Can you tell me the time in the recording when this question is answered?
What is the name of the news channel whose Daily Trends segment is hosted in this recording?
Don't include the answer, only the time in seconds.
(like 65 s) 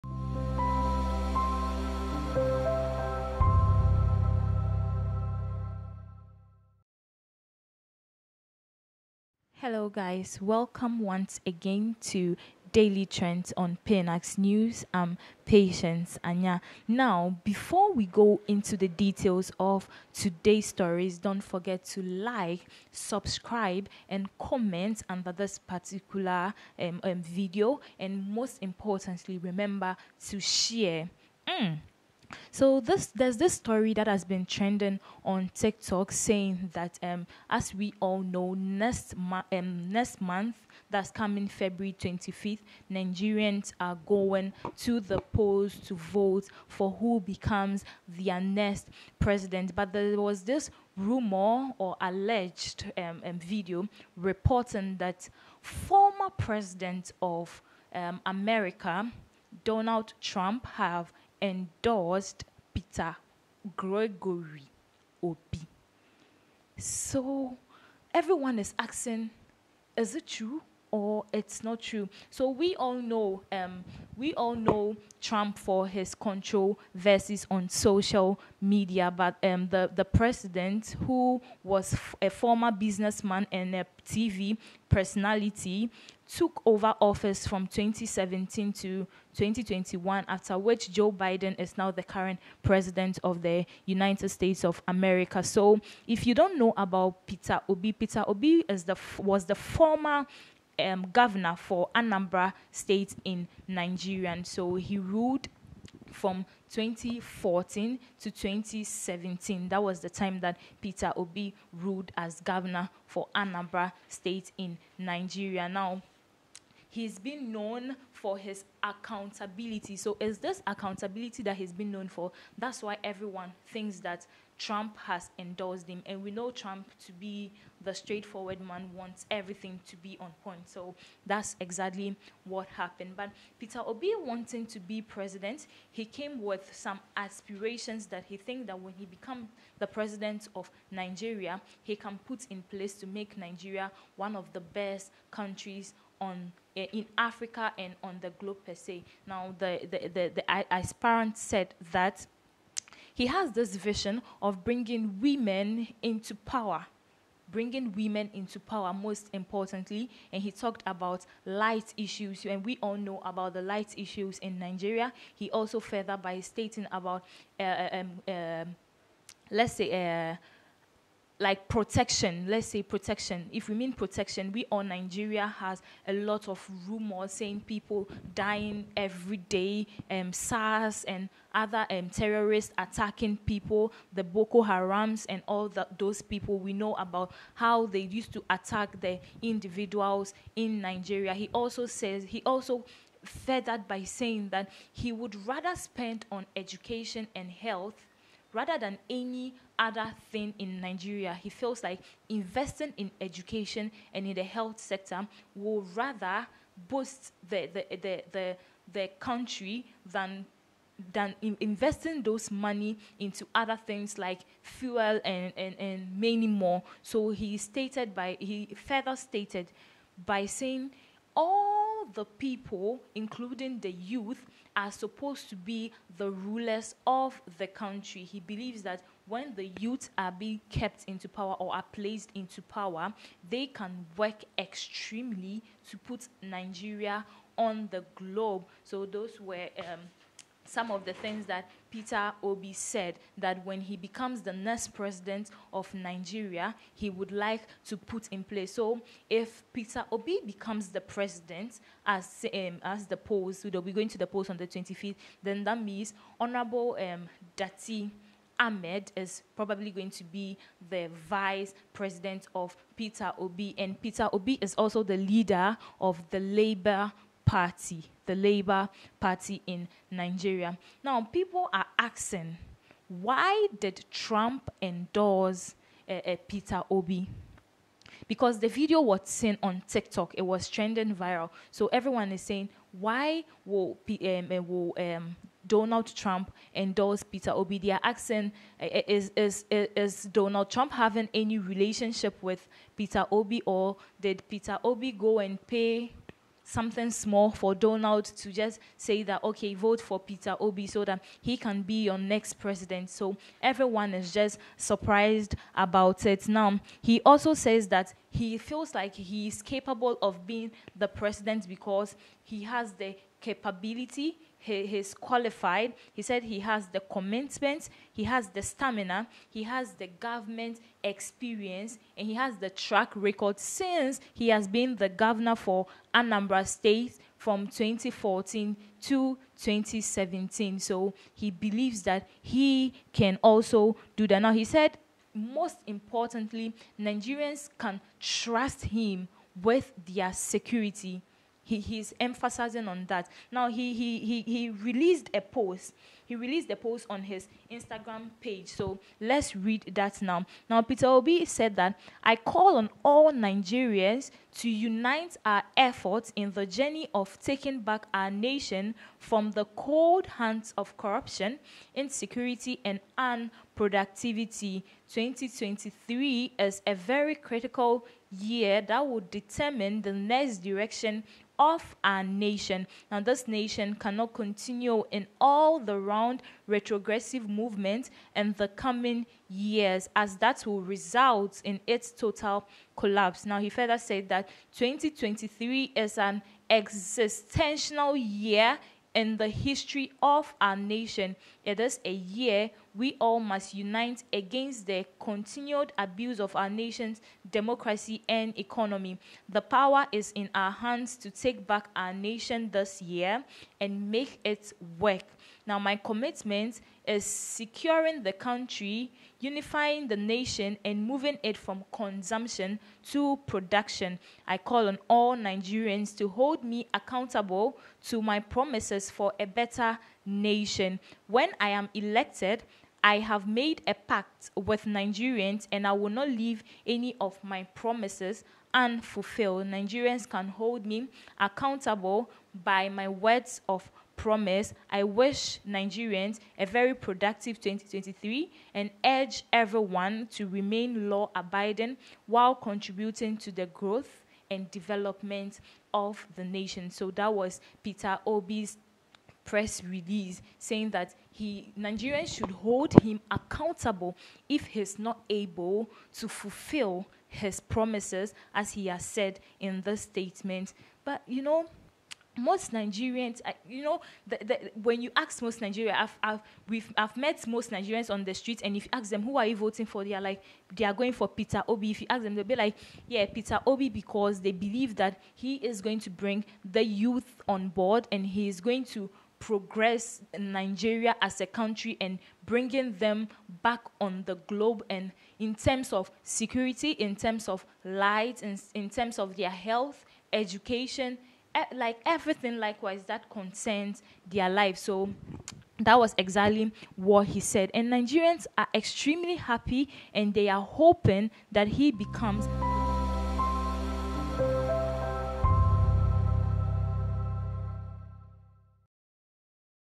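13 s.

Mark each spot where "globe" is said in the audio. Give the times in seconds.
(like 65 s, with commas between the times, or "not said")
148 s, 238 s, 484 s.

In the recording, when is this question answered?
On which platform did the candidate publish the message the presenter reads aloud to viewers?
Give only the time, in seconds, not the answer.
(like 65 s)
347 s.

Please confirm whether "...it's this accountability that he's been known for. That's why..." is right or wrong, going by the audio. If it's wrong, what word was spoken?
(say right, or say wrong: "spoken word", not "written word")
right.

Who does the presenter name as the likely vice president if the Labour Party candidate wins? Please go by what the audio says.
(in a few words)
Datti Ahmed.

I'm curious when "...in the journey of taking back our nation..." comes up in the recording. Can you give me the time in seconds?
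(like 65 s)
356 s.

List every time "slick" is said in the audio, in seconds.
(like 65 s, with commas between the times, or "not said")
not said.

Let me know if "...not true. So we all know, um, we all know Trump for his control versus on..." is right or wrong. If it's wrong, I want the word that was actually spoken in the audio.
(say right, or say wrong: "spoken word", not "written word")
right.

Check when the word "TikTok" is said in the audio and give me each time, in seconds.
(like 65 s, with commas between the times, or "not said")
35 s, 279 s.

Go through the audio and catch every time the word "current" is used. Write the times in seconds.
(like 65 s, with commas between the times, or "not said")
92 s.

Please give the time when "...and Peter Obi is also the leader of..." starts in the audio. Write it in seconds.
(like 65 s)
263 s.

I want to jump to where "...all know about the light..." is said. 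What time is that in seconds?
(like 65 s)
162 s.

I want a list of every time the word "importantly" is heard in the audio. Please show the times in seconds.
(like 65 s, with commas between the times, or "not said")
28 s, 159 s, 335 s.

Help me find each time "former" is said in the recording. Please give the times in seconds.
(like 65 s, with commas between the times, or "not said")
55 s, 82 s, 99 s.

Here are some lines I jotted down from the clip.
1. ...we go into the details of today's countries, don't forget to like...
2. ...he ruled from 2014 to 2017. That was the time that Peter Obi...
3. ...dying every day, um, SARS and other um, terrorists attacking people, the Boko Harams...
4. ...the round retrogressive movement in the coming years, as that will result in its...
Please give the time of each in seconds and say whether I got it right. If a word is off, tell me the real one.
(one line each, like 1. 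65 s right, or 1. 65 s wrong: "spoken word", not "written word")
1. 17 s wrong: "stories", not "countries"
2. 104 s right
3. 178 s right
4. 375 s right.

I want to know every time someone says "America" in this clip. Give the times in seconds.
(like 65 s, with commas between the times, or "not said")
58 s, 94 s.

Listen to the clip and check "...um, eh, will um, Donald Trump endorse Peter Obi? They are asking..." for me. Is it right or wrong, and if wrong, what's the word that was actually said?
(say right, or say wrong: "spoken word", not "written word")
right.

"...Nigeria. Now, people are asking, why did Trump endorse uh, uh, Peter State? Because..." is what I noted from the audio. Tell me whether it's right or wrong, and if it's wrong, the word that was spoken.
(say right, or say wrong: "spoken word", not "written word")
wrong: "Obi", not "State".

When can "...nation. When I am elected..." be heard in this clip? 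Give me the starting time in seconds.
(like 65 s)
420 s.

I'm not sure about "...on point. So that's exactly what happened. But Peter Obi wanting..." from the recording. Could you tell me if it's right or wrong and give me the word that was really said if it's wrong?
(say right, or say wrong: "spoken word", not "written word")
right.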